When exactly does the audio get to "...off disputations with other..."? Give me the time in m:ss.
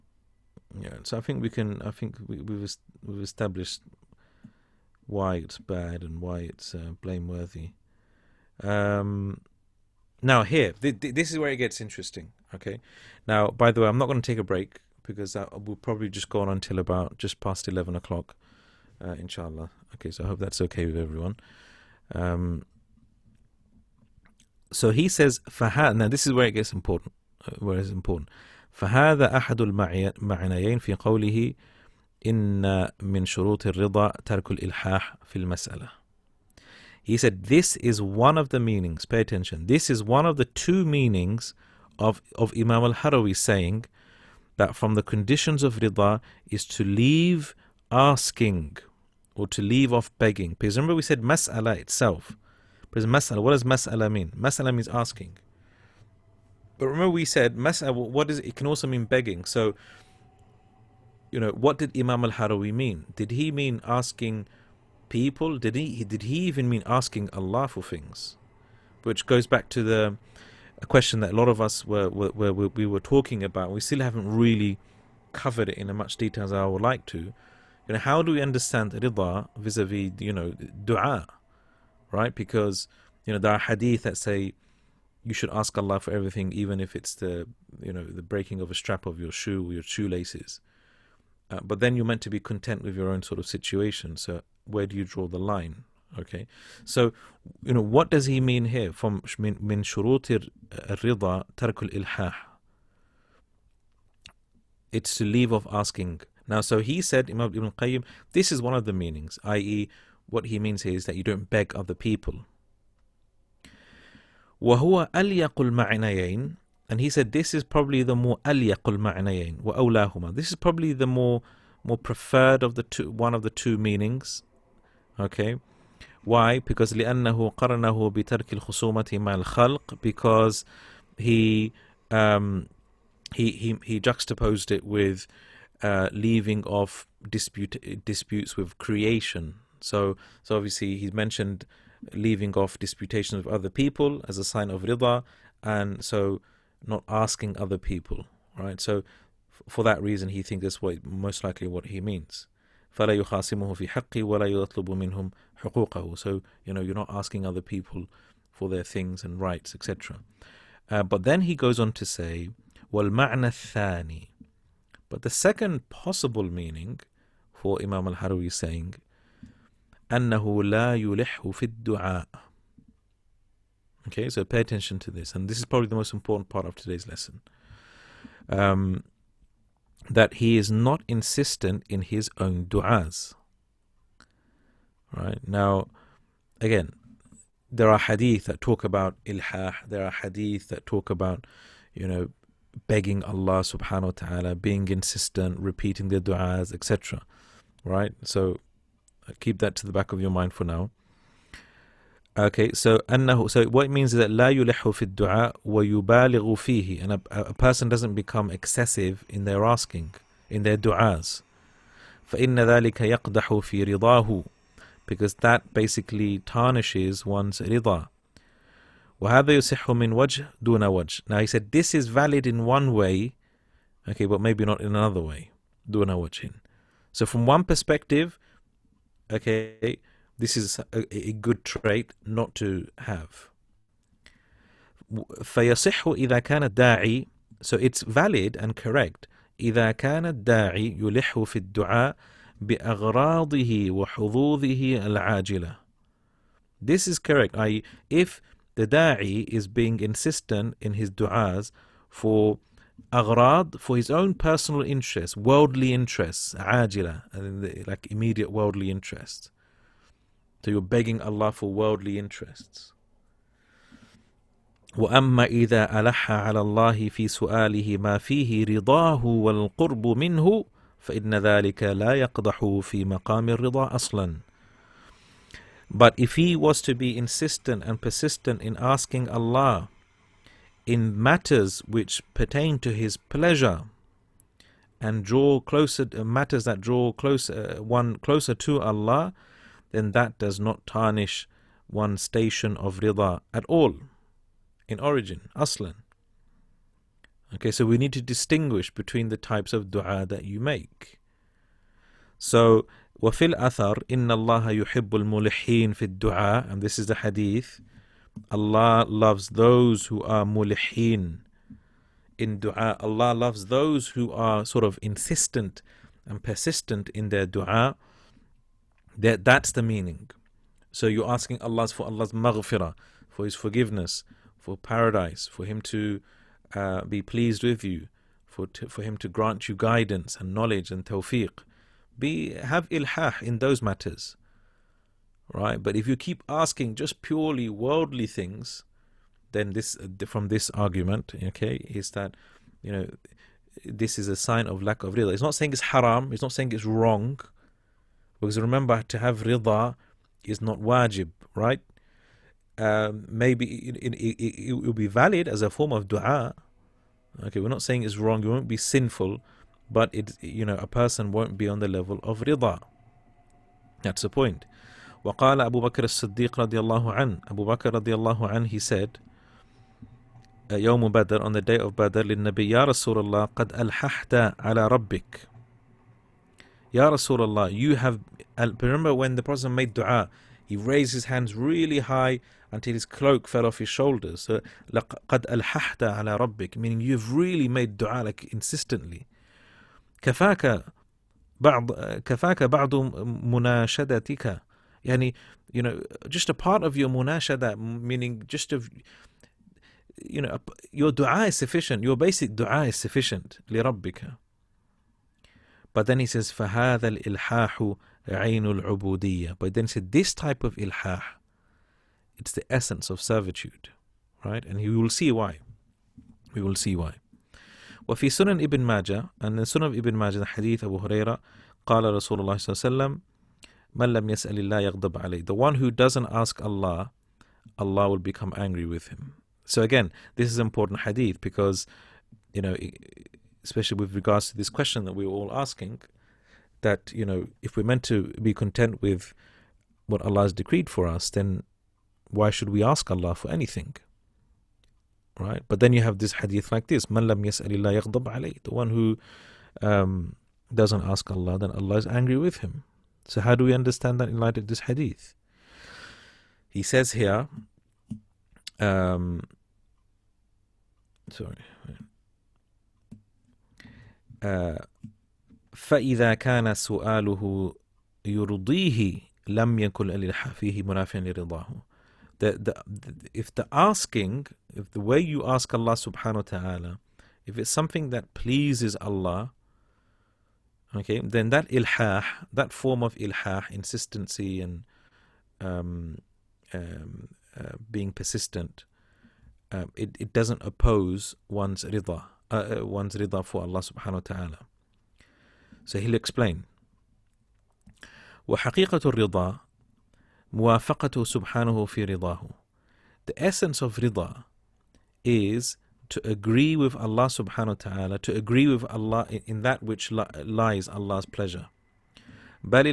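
2:22.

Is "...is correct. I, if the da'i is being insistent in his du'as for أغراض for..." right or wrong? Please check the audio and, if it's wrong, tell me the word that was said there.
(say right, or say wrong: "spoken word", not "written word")
right.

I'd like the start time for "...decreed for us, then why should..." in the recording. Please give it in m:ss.
7:20.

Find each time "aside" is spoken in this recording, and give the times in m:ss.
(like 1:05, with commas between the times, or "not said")
not said.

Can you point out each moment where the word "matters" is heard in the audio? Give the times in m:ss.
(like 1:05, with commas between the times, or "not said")
4:41, 4:46, 5:33.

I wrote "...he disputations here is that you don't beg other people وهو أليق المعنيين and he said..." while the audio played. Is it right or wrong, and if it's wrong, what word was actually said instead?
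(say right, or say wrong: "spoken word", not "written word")
wrong: "means", not "disputations".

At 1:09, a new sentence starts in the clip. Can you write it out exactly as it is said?
Which goes back to the a question that a lot of us were, were, were, we were talking about.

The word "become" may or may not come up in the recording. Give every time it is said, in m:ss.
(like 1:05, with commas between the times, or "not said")
3:28, 7:08.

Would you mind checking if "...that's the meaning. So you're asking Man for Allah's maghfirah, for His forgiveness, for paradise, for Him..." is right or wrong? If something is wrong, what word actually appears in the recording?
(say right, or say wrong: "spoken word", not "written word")
wrong: "Allah", not "Man".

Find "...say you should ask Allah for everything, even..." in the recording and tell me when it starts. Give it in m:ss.
1:24.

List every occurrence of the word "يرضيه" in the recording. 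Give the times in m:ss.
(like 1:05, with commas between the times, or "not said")
7:48.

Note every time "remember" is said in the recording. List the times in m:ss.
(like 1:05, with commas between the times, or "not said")
0:50, 0:56, 5:48, 6:18.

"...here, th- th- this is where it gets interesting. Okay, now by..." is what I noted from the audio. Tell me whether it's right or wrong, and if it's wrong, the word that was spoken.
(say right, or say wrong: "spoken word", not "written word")
right.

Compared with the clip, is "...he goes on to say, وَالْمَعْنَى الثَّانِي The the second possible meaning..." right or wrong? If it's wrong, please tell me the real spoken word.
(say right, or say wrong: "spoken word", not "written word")
wrong: "But", not "The".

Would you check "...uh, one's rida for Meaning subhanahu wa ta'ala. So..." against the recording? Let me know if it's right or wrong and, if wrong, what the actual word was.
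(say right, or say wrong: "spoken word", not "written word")
wrong: "Allah", not "Meaning".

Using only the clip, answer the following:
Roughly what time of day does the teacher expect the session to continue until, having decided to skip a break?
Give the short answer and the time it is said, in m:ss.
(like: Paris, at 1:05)
just past 11 o'clock, at 0:17.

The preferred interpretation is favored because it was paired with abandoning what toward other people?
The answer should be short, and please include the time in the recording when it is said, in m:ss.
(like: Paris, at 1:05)
disputes, at 2:18.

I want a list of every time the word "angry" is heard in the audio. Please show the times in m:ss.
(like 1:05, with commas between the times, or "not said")
7:08, 7:32.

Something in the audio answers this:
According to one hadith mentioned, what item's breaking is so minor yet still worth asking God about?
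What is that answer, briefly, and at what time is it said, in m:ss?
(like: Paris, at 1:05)
shoelaces, at 1:29.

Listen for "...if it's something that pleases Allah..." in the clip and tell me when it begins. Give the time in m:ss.
7:57.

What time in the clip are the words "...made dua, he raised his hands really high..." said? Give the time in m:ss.
6:19.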